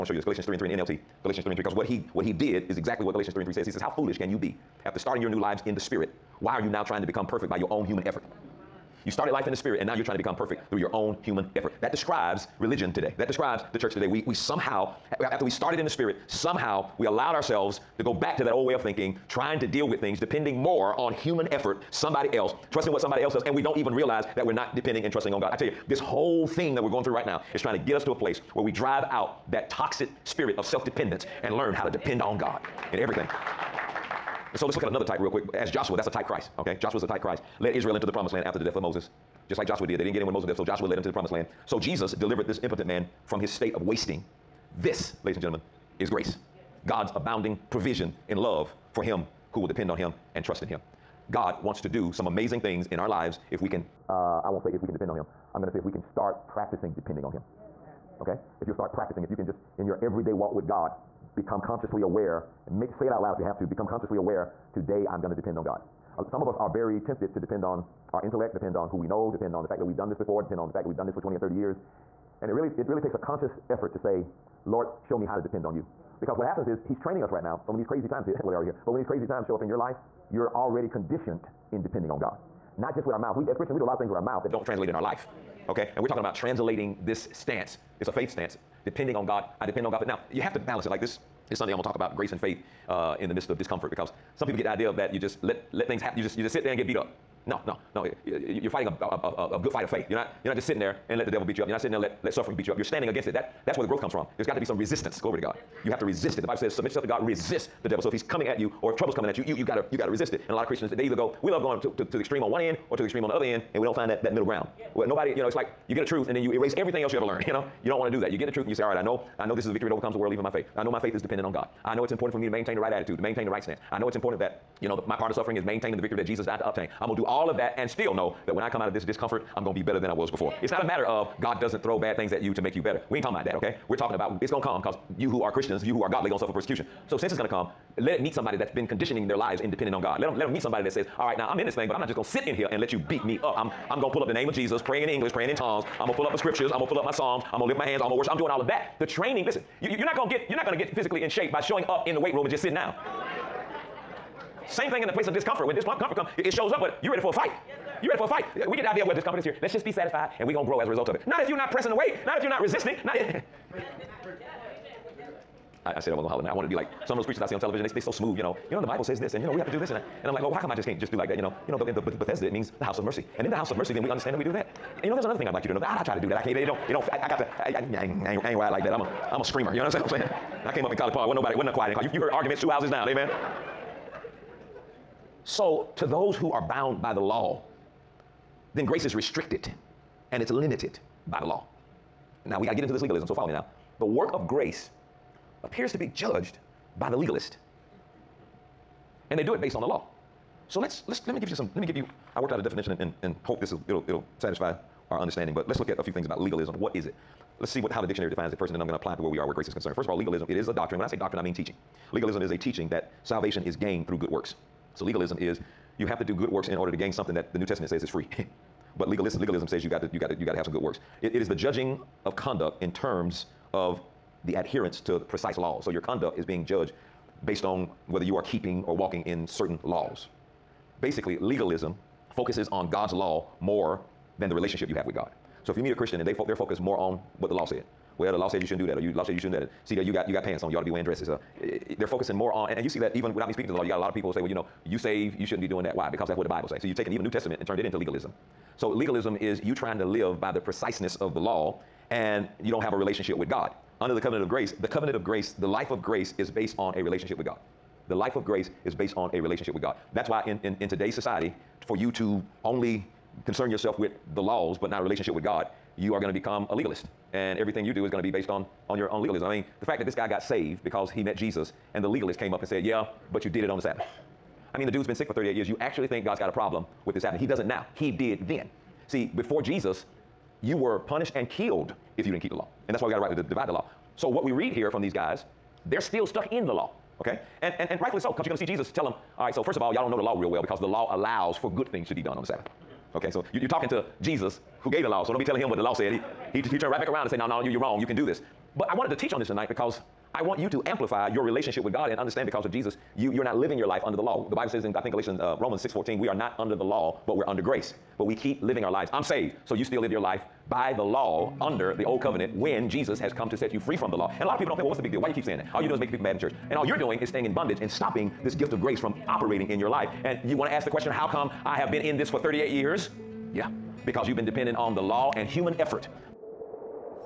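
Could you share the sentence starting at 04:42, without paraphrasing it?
And that's why we got to rightly divide the law.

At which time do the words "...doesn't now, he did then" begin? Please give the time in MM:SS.
04:37.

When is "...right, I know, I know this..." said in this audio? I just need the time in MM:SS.
01:58.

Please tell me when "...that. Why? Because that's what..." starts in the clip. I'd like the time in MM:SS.
04:05.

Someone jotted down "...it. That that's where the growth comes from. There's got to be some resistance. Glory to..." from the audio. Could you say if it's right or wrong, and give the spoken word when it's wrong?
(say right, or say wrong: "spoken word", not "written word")
right.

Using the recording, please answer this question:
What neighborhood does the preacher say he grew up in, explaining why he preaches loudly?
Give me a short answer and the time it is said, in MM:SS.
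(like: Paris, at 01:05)
College Park, at 03:00.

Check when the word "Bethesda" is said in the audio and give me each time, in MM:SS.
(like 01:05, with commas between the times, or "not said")
02:51.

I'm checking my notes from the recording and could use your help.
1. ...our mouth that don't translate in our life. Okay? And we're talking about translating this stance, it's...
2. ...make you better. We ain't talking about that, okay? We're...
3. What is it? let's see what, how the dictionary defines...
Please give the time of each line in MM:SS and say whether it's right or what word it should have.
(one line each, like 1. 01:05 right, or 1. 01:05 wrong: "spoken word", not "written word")
1. 01:24 right
2. 02:12 right
3. 03:26 right.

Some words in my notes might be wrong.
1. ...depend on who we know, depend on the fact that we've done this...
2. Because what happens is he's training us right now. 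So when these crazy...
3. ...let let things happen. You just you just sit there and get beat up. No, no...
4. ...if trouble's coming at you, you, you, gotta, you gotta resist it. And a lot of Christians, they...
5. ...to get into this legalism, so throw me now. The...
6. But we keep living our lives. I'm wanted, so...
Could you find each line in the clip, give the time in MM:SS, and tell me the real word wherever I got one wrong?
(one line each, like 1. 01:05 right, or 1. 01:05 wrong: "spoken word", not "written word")
1. 01:08 right
2. 01:16 right
3. 01:35 right
4. 01:48 right
5. 03:12 wrong: "follow", not "throw"
6. 05:08 wrong: "saved", not "wanted".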